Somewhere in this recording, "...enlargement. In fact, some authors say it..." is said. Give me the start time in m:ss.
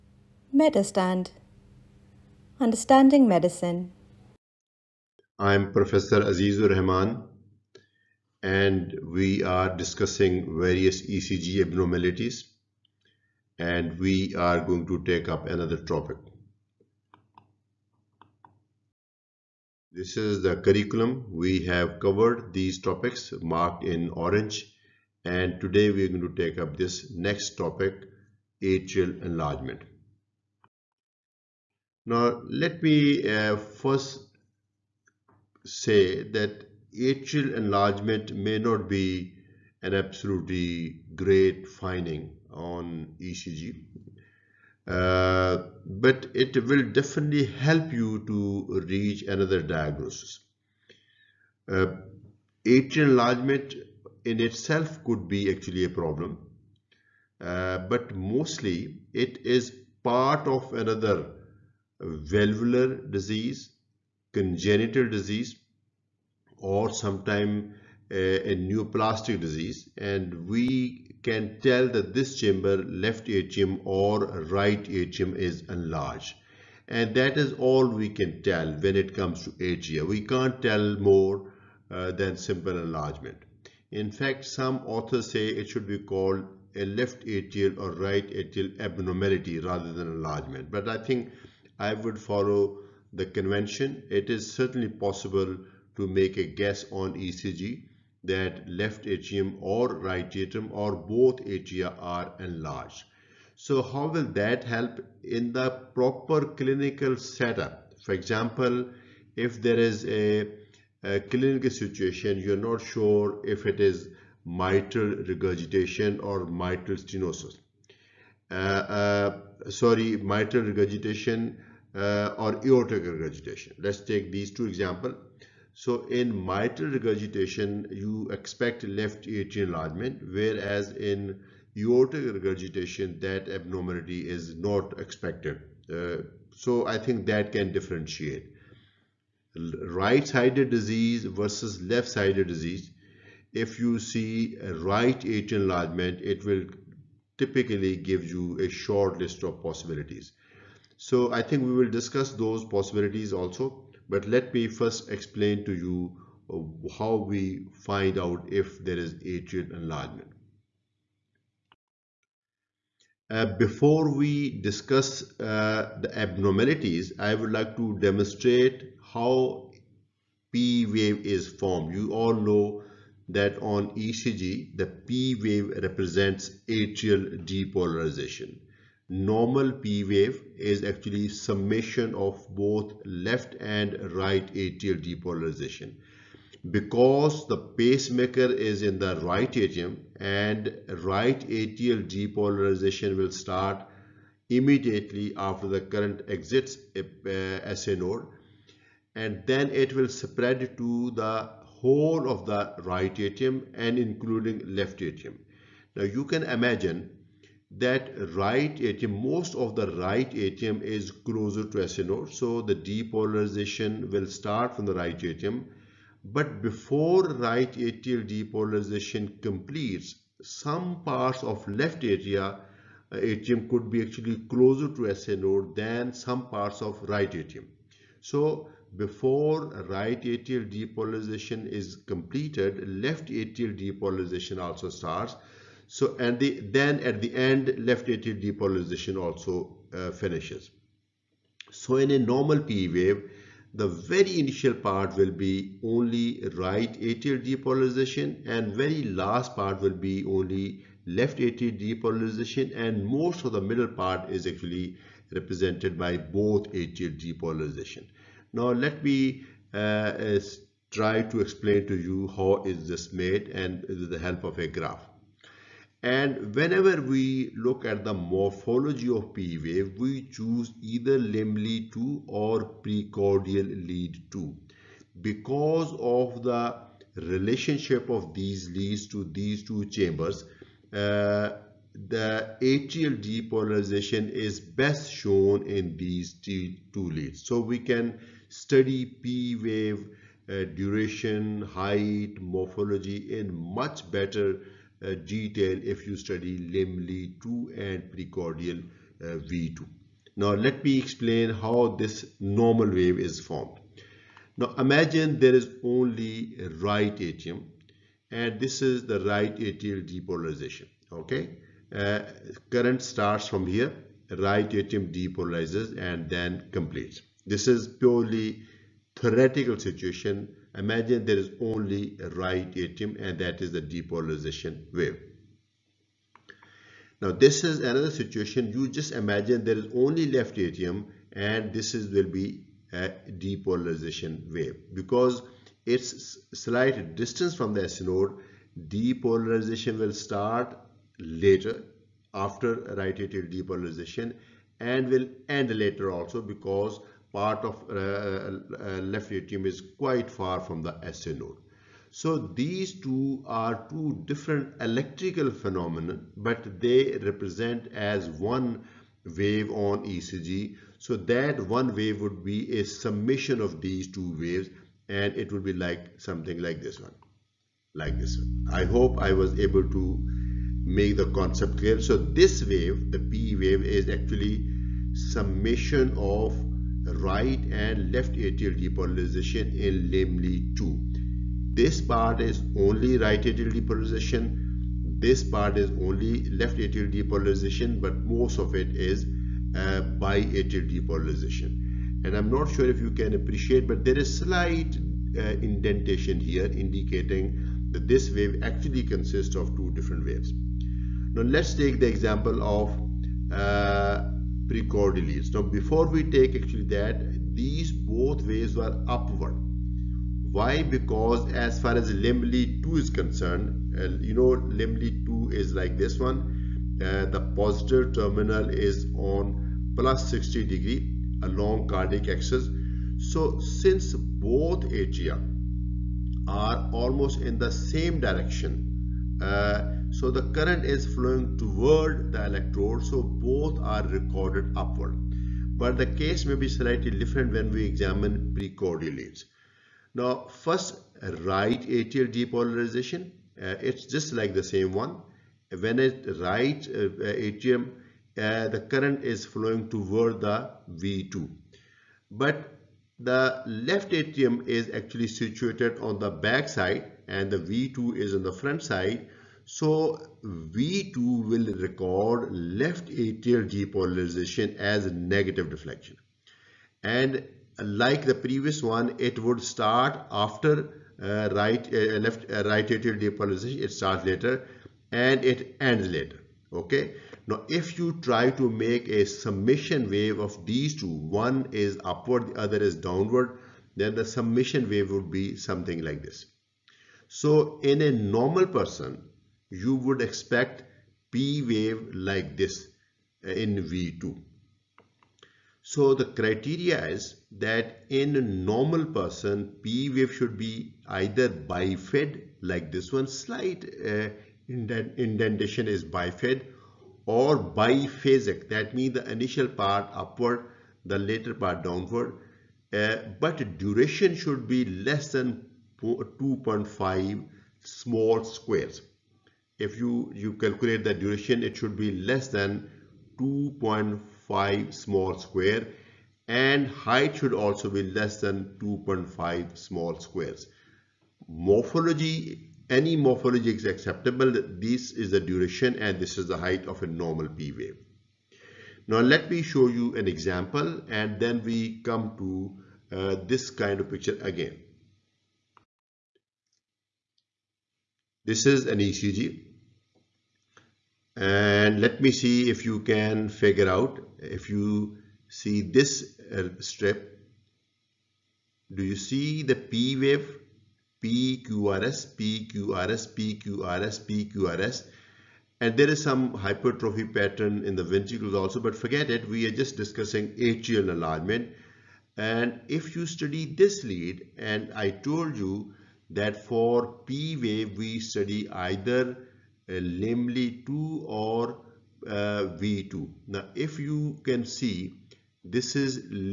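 1:22.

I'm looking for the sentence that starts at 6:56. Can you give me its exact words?
Uh, the positive terminal is on plus 60 degree along cardiac axis.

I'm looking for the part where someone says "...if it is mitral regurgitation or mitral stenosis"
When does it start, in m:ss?
1:53.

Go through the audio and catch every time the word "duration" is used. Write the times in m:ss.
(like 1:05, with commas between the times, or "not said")
4:50, 8:33, 8:41, 8:55.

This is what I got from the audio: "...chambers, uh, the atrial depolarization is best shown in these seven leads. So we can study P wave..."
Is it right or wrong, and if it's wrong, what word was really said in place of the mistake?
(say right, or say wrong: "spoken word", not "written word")
wrong: "two", not "seven".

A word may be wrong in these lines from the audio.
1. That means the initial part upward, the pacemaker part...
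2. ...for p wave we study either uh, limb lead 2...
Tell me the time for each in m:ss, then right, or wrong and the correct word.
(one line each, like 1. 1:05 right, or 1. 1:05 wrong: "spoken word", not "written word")
1. 8:28 wrong: "later", not "pacemaker"
2. 9:36 right.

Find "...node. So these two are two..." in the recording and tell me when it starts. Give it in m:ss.
5:51.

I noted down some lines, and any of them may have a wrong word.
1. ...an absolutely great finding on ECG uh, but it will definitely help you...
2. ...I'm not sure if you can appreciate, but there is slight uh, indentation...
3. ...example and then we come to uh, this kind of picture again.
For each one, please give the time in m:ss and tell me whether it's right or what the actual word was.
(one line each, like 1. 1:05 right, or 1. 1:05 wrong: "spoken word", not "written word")
1. 0:39 right
2. 6:32 right
3. 9:00 right.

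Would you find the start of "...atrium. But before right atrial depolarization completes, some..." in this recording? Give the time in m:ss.
3:35.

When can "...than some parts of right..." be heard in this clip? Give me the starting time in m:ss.
3:45.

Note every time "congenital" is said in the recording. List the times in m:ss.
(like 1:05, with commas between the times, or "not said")
1:04.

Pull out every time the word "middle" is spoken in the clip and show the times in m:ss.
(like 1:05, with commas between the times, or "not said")
4:13.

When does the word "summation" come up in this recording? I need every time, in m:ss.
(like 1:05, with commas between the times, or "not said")
3:01, 6:02, 6:15, 7:59, 8:04.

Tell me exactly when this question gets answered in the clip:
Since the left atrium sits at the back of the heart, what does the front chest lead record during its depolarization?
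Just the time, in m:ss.
7:45.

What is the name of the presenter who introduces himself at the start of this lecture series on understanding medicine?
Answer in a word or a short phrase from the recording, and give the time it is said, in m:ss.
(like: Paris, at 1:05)
Azizur Rahman, at 0:06.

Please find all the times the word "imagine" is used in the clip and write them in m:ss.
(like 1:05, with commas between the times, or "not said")
3:26, 5:04, 5:20, 5:29.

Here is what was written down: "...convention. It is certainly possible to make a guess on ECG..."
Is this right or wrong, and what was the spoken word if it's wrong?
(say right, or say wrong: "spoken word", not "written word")
right.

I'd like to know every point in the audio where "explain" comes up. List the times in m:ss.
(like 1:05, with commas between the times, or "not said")
2:35, 4:21, 5:00.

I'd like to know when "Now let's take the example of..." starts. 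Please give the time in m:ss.
6:41.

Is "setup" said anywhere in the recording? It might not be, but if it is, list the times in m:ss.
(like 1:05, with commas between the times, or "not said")
1:47.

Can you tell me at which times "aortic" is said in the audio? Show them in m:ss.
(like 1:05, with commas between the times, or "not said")
2:02, 2:11.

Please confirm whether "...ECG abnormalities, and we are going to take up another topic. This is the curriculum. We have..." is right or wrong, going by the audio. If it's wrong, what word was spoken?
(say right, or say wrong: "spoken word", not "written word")
right.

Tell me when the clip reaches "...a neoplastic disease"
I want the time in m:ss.
1:08.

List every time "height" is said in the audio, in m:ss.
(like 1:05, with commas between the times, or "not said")
4:51, 8:46, 8:56.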